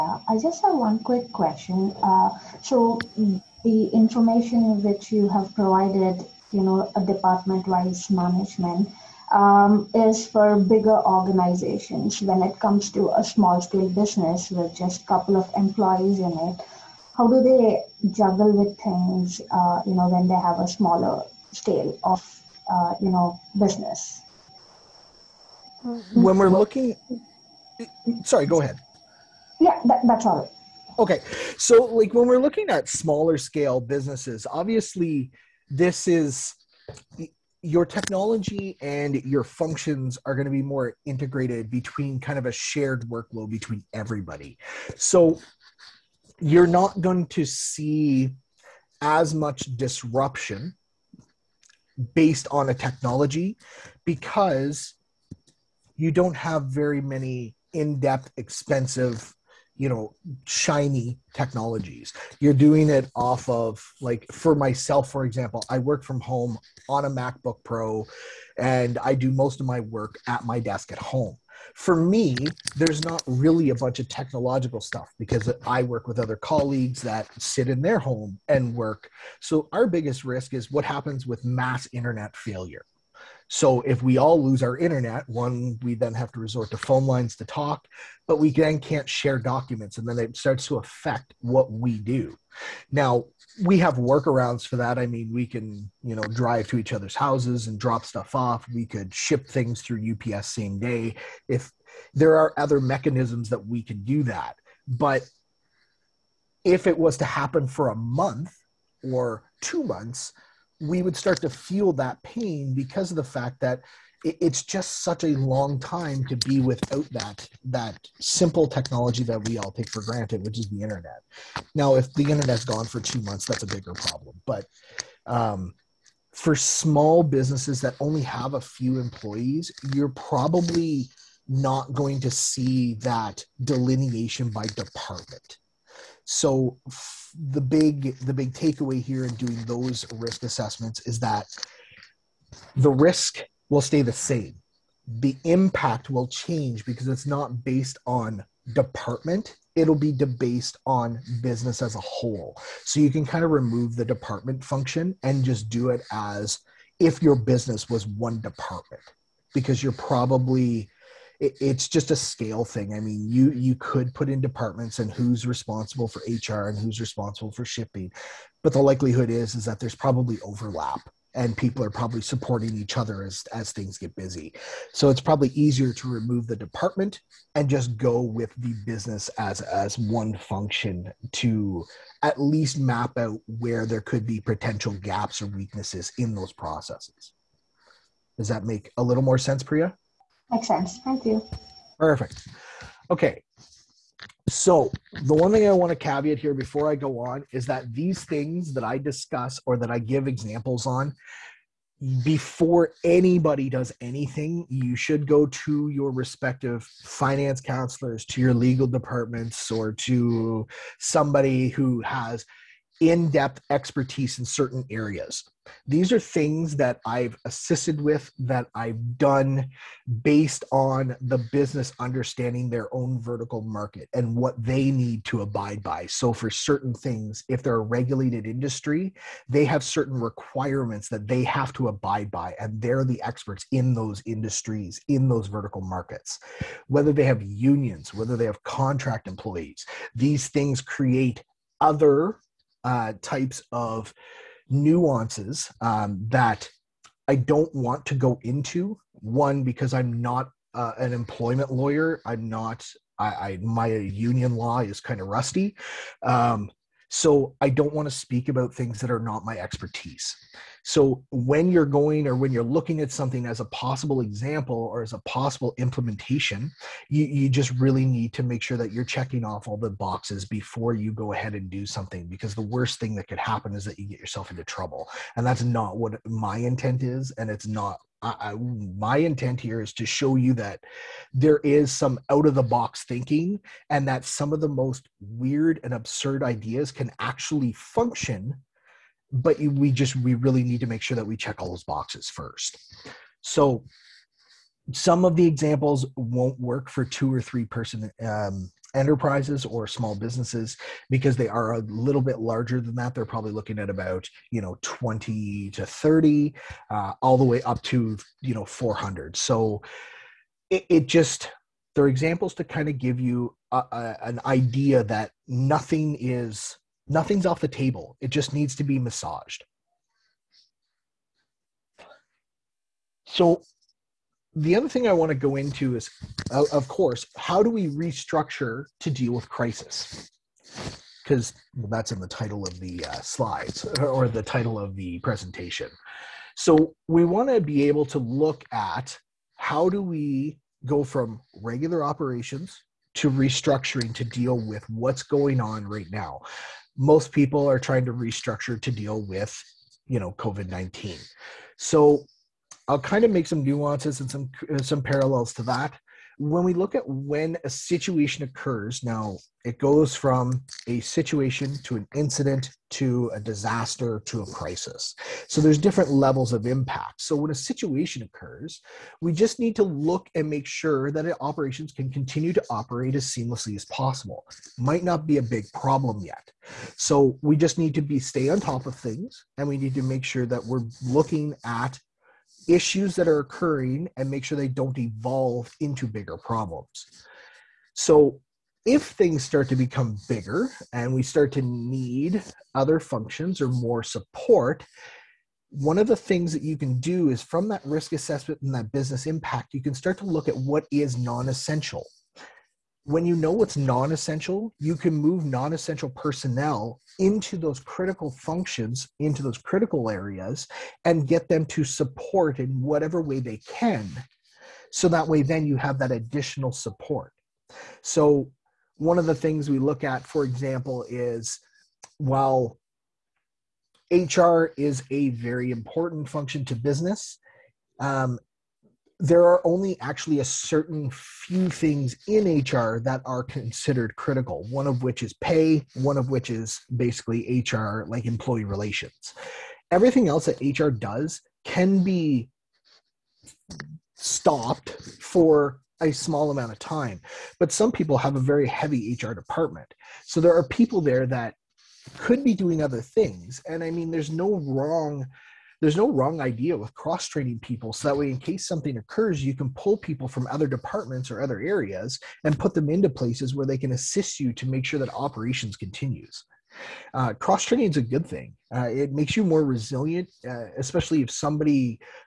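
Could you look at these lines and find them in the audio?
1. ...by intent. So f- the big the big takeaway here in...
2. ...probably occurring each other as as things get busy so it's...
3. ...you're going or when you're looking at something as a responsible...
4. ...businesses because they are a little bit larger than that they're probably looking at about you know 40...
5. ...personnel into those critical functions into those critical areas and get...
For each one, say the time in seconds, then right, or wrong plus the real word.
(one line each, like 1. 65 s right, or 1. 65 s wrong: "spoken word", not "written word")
1. 134 s wrong: "department", not "intent"
2. 171 s wrong: "supporting", not "occurring"
3. 261 s wrong: "possible", not "responsible"
4. 300 s wrong: "20", not "40"
5. 406 s right.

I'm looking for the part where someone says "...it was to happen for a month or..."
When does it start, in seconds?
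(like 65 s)
106 s.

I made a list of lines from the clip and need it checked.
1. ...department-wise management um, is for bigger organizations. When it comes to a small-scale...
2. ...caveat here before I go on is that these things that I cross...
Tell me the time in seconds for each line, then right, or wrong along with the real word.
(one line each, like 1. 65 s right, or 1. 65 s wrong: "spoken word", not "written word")
1. 7 s right
2. 195 s wrong: "discuss", not "cross".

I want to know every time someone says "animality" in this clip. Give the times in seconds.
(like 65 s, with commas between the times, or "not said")
not said.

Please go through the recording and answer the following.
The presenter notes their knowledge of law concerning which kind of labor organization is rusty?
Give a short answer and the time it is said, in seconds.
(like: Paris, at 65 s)
Union law, at 253 s.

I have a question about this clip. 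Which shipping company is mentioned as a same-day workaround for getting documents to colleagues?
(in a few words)
UPS.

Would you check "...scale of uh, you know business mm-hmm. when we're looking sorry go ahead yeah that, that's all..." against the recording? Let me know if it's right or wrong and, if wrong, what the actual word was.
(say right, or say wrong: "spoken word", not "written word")
right.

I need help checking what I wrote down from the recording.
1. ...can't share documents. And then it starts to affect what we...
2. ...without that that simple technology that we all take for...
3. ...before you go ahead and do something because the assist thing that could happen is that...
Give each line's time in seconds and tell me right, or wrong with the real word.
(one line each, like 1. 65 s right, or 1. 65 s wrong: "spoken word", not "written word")
1. 88 s right
2. 116 s right
3. 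270 s wrong: "worst", not "assist".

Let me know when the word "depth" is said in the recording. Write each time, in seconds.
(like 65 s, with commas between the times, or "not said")
57 s, 213 s.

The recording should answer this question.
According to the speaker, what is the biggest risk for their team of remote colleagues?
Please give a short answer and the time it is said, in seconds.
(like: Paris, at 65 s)
Mass internet failure, at 81 s.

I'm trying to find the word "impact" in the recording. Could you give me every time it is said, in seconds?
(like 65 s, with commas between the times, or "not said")
145 s, 366 s, 399 s.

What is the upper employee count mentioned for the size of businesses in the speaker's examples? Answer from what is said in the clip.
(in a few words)
400.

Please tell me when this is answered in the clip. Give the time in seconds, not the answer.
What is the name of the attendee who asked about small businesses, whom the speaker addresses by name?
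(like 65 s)
189 s.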